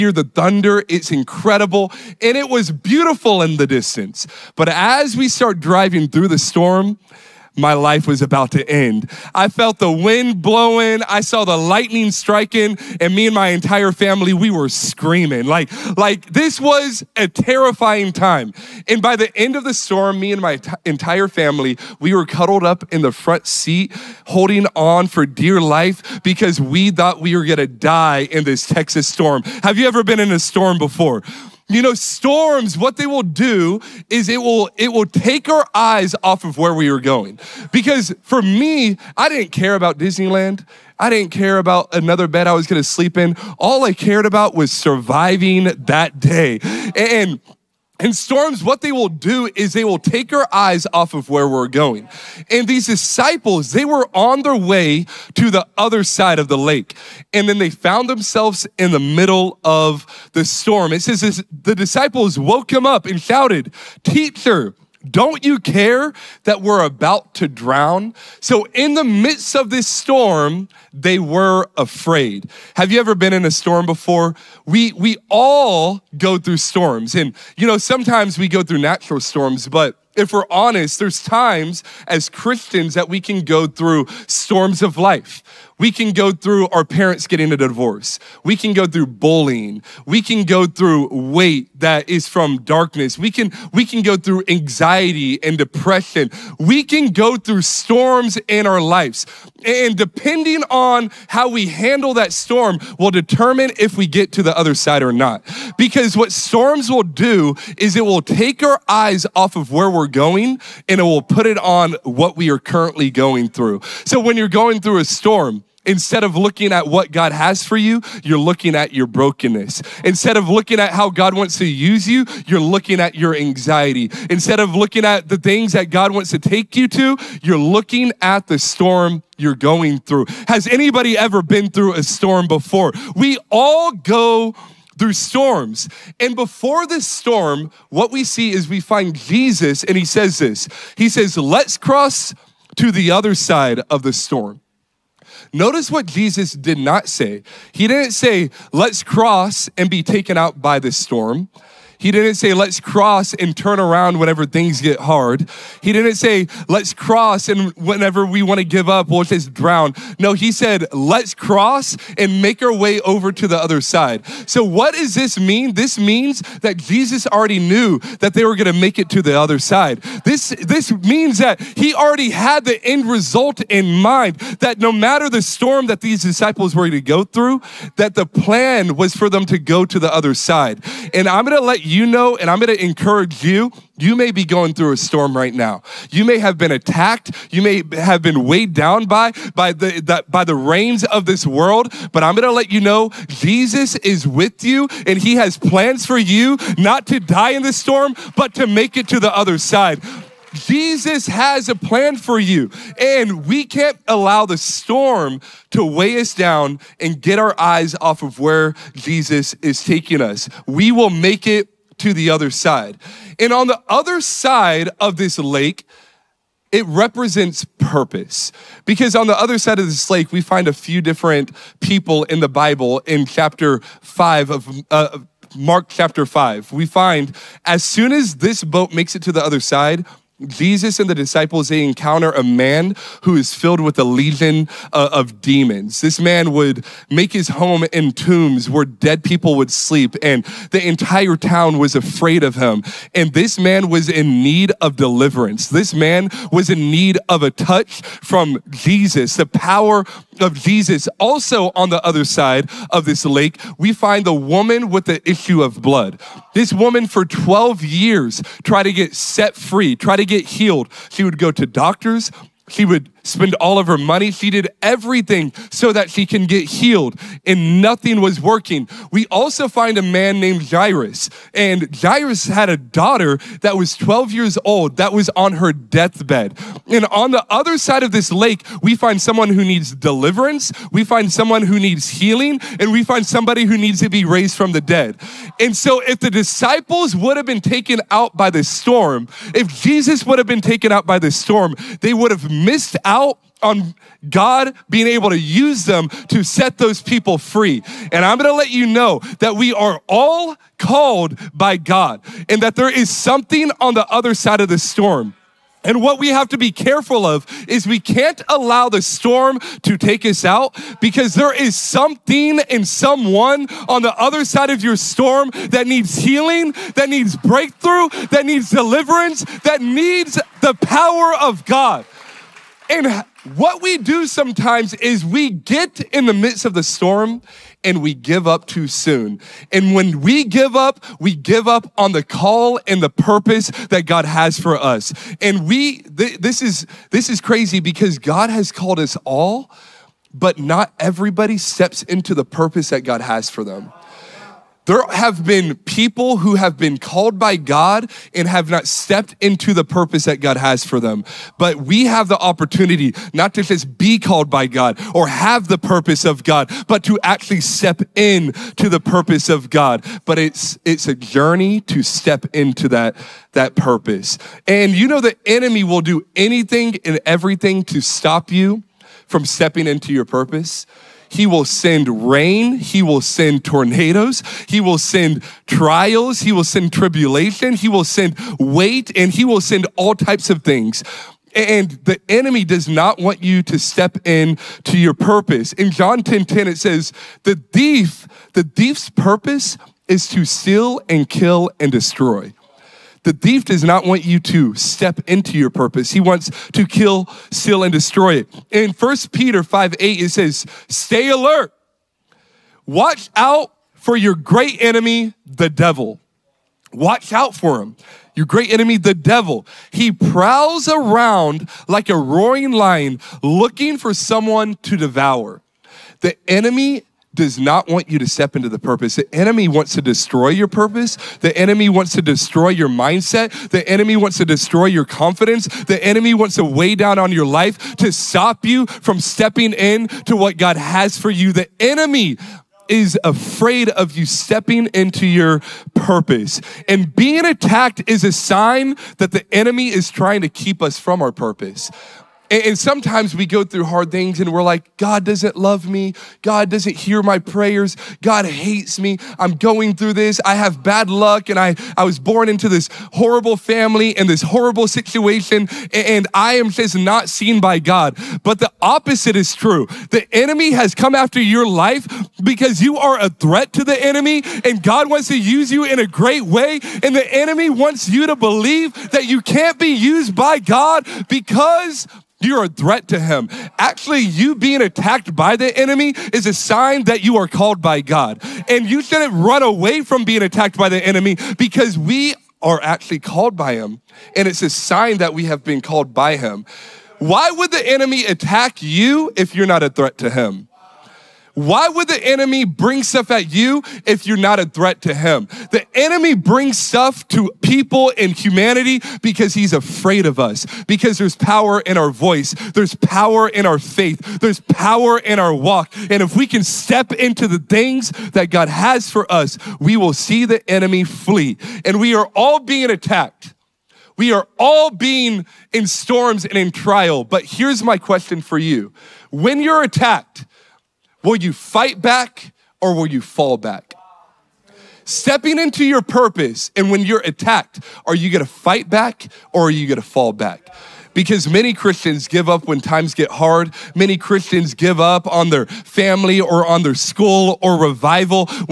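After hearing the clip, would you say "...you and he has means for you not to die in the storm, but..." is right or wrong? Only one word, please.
wrong.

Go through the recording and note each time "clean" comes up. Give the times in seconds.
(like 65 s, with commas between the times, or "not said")
not said.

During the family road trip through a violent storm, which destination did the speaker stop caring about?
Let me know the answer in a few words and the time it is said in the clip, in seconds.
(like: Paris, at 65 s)
Disneyland, at 39 s.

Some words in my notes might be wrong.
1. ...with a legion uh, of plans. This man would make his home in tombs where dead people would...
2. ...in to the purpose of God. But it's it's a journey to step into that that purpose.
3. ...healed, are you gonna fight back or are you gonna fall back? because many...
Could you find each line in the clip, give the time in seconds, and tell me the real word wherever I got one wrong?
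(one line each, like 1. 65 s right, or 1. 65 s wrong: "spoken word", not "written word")
1. 233 s wrong: "demons", not "plans"
2. 358 s right
3. 527 s wrong: "attacked", not "healed".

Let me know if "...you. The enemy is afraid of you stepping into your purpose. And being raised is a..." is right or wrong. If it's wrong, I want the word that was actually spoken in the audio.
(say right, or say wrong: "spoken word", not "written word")
wrong: "attacked", not "raised".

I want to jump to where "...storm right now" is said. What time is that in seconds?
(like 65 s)
184 s.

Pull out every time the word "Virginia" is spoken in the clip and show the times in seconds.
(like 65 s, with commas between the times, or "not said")
not said.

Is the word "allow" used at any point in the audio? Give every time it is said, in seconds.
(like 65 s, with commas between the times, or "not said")
204 s, 308 s.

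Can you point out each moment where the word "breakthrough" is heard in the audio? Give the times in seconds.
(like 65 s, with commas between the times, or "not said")
317 s.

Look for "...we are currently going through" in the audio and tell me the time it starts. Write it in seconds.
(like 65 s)
112 s.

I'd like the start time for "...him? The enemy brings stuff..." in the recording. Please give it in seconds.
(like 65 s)
495 s.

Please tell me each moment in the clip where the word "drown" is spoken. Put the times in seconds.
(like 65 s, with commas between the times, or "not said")
67 s, 159 s.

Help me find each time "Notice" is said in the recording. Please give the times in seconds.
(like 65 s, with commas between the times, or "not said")
145 s.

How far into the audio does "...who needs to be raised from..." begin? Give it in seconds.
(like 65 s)
283 s.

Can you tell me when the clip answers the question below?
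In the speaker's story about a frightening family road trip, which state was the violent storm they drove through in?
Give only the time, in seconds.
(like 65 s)
28 s.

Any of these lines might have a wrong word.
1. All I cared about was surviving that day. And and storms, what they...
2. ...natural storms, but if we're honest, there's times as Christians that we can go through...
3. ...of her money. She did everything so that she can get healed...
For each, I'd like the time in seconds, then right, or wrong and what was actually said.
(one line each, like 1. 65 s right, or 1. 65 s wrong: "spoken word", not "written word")
1. 43 s right
2. 78 s right
3. 263 s right.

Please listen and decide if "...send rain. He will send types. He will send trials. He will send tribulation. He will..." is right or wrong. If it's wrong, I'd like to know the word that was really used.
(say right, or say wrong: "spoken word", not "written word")
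wrong: "tornadoes", not "types".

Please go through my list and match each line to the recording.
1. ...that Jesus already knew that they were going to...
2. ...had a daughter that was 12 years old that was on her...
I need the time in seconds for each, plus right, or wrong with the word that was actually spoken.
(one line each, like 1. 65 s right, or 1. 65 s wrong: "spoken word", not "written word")
1. 166 s right
2. 272 s right.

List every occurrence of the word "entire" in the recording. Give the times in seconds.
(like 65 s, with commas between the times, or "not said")
13 s, 20 s, 240 s.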